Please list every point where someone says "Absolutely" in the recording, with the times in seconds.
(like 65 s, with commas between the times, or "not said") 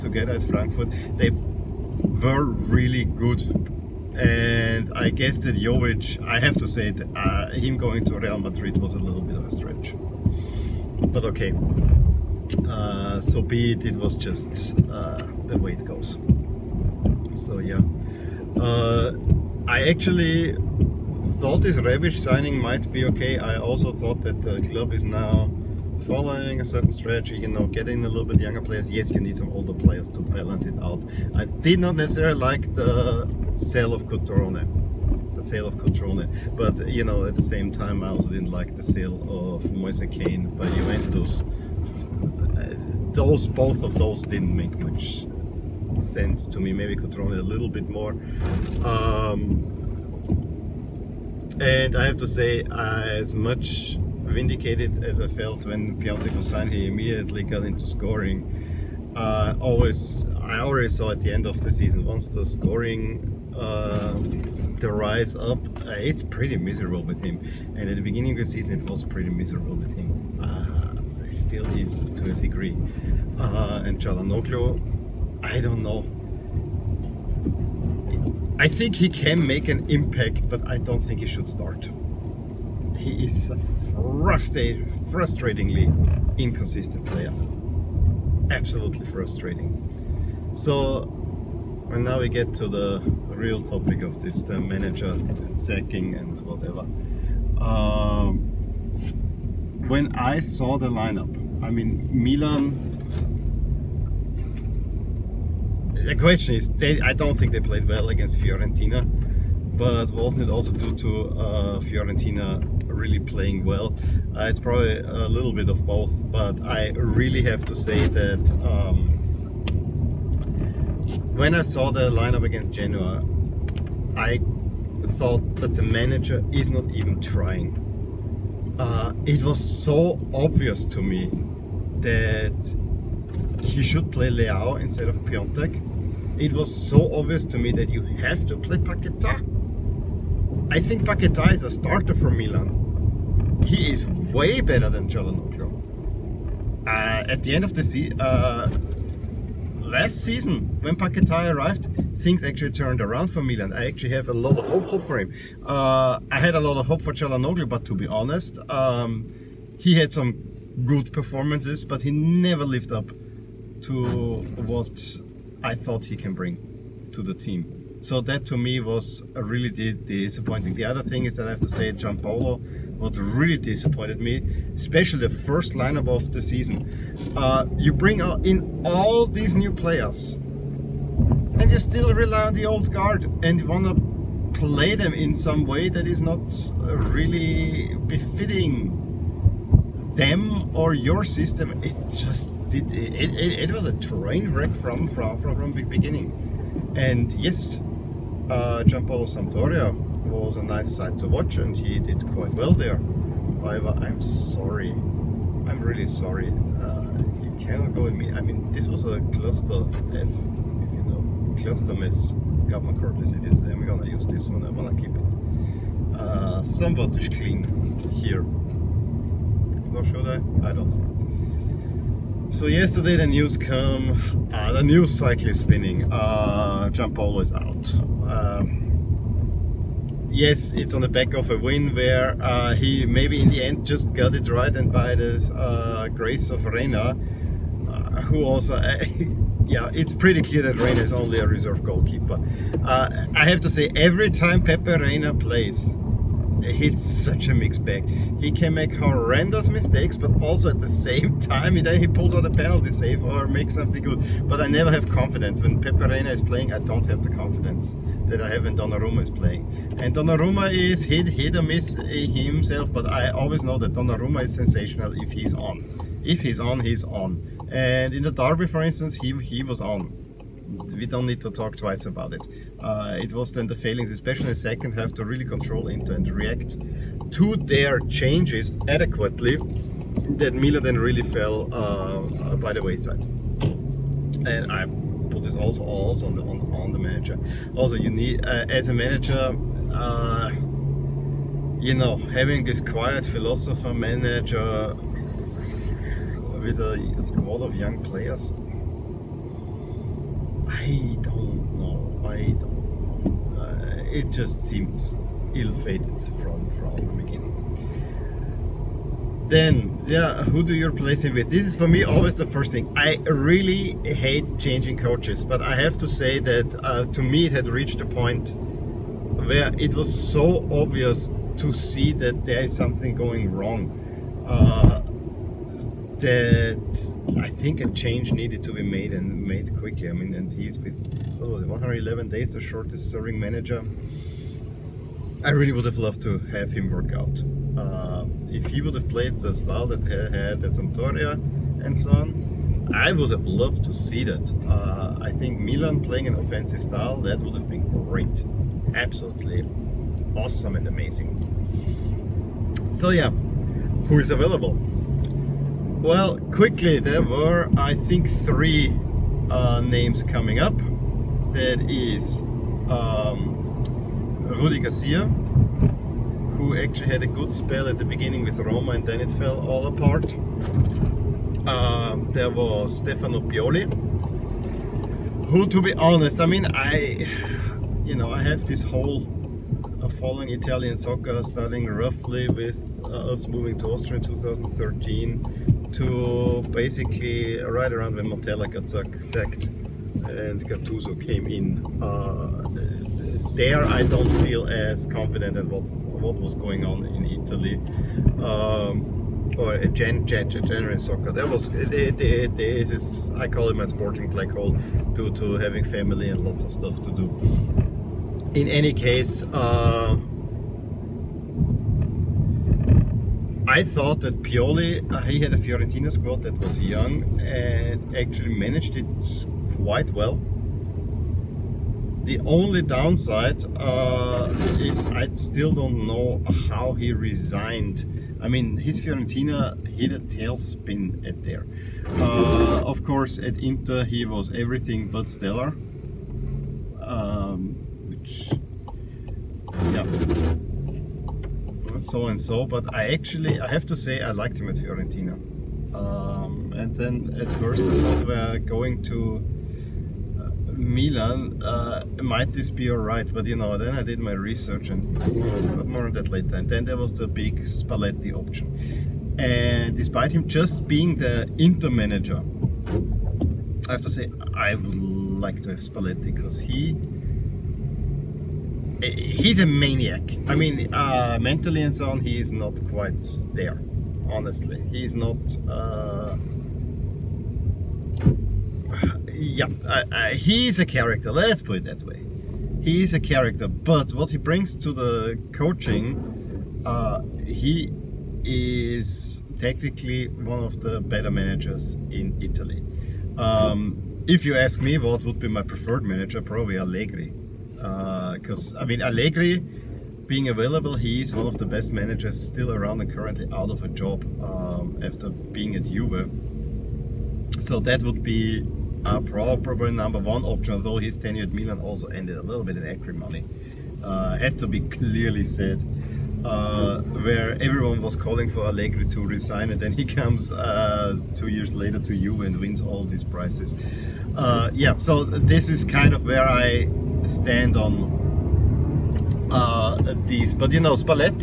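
88 s, 348 s.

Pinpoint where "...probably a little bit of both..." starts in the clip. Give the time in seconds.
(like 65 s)
114 s.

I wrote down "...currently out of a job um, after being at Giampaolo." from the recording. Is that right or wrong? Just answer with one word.
wrong.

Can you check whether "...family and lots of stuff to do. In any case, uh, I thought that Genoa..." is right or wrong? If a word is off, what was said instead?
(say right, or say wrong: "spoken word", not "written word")
wrong: "Pioli", not "Genoa".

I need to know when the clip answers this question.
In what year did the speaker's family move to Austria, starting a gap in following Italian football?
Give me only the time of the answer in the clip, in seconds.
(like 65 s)
384 s.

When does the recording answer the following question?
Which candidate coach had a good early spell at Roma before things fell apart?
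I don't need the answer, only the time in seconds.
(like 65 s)
364 s.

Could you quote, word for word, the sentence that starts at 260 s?
And Donnarumma is hit, hit or miss eh, himself, but I always know that Donnarumma is sensational if he's on.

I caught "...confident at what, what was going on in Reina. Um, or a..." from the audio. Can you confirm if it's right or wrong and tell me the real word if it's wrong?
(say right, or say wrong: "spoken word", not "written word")
wrong: "Italy", not "Reina".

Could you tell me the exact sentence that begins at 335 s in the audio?
I really would have loved to have him work out.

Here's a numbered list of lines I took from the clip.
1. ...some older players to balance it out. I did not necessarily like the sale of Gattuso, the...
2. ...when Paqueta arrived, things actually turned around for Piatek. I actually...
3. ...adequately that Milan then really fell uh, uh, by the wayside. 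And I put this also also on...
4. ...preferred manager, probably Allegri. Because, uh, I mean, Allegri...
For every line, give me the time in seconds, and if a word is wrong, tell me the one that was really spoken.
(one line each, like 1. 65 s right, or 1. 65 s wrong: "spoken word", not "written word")
1. 29 s wrong: "Cutrone", not "Gattuso"
2. 150 s wrong: "Milan", not "Piatek"
3. 278 s right
4. 495 s right.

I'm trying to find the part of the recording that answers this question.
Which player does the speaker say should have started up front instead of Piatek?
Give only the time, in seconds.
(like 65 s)
134 s.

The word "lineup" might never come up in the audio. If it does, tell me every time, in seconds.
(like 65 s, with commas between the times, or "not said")
100 s, 122 s, 175 s.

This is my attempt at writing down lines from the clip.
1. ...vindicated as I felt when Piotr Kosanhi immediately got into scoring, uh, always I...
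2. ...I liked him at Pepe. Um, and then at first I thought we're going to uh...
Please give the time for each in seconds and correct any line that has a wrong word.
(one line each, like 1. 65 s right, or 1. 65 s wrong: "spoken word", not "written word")
1. 53 s right
2. 444 s wrong: "Fiorentina", not "Pepe".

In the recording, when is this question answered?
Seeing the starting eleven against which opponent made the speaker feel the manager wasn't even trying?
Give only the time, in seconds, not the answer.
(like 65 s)
122 s.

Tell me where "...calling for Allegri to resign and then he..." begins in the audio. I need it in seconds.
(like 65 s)
518 s.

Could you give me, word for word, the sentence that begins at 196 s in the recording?
And yes, uh, Giampaolo Sampdoria was a nice sight to watch and he did quite well there.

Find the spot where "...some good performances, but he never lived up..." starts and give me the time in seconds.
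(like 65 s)
160 s.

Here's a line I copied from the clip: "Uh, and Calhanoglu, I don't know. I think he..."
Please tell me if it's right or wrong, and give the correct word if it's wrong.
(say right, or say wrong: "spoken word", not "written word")
right.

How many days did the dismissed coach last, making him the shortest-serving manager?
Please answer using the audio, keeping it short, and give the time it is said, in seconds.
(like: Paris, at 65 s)
111, at 331 s.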